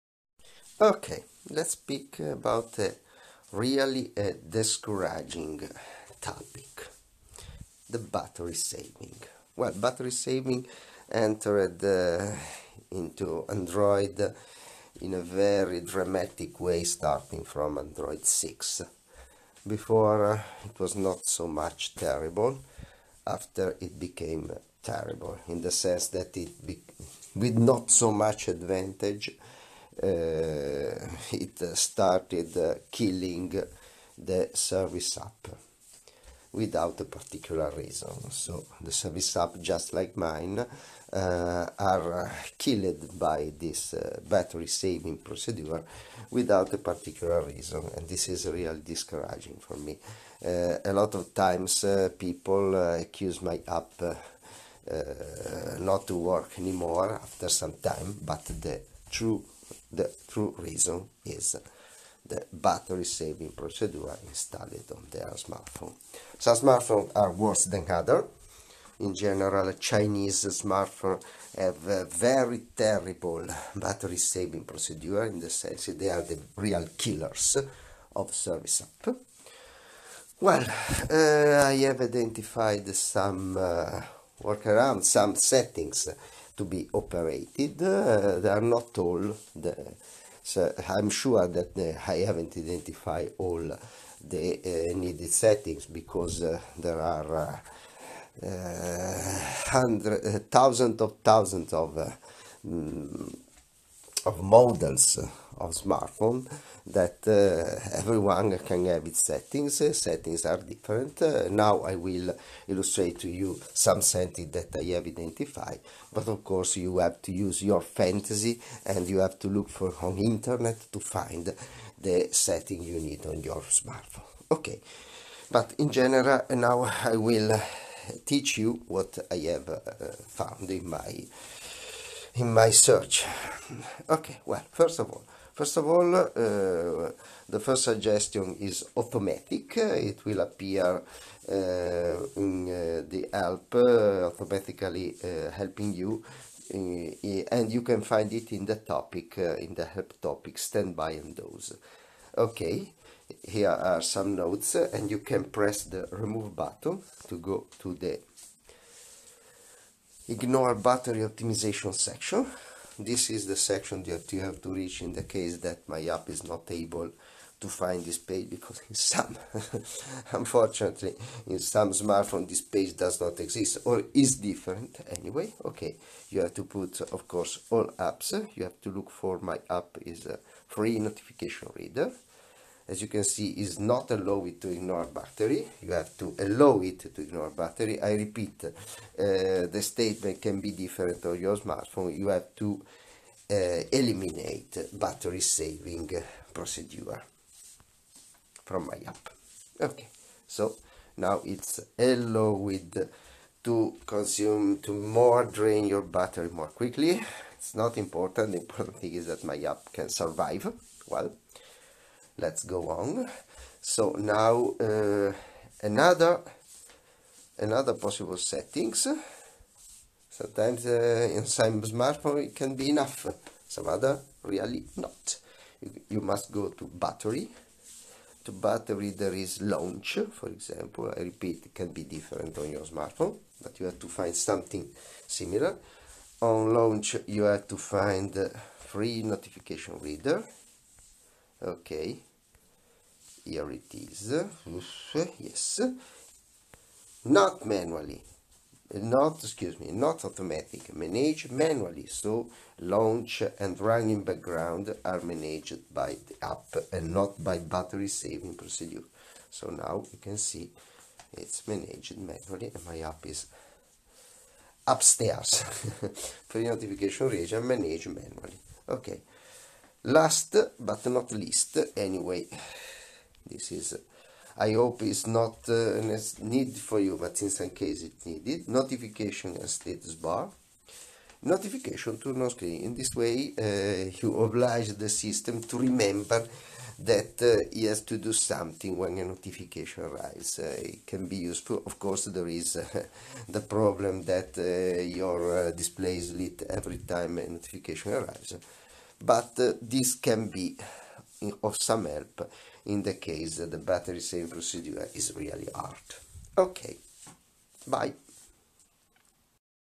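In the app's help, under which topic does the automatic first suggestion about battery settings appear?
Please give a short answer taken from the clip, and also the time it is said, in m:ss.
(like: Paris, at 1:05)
standby and doze, at 2:30.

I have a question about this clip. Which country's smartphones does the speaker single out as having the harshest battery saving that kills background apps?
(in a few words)
Chinese.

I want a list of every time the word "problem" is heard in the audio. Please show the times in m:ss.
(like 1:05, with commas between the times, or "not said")
4:53.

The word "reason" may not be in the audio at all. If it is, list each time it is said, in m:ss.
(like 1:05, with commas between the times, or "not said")
0:37, 0:47, 1:00.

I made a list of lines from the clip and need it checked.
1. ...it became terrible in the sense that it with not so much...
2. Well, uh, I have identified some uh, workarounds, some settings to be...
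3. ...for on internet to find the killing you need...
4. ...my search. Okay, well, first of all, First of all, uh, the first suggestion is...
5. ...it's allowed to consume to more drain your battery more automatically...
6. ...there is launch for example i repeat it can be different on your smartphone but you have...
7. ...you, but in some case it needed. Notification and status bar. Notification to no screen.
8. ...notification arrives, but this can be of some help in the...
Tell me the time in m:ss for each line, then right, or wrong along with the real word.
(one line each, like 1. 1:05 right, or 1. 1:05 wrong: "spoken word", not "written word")
1. 0:23 right
2. 1:20 right
3. 1:59 wrong: "setting", not "killing"
4. 2:12 right
5. 3:21 wrong: "quickly", not "automatically"
6. 3:49 right
7. 4:36 right
8. 4:57 right.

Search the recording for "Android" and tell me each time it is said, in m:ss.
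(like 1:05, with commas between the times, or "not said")
0:13, 0:17.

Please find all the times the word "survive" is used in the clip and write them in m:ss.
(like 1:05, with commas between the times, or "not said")
3:30.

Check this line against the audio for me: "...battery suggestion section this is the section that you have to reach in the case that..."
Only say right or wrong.
wrong.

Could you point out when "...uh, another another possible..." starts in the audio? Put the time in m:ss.
3:34.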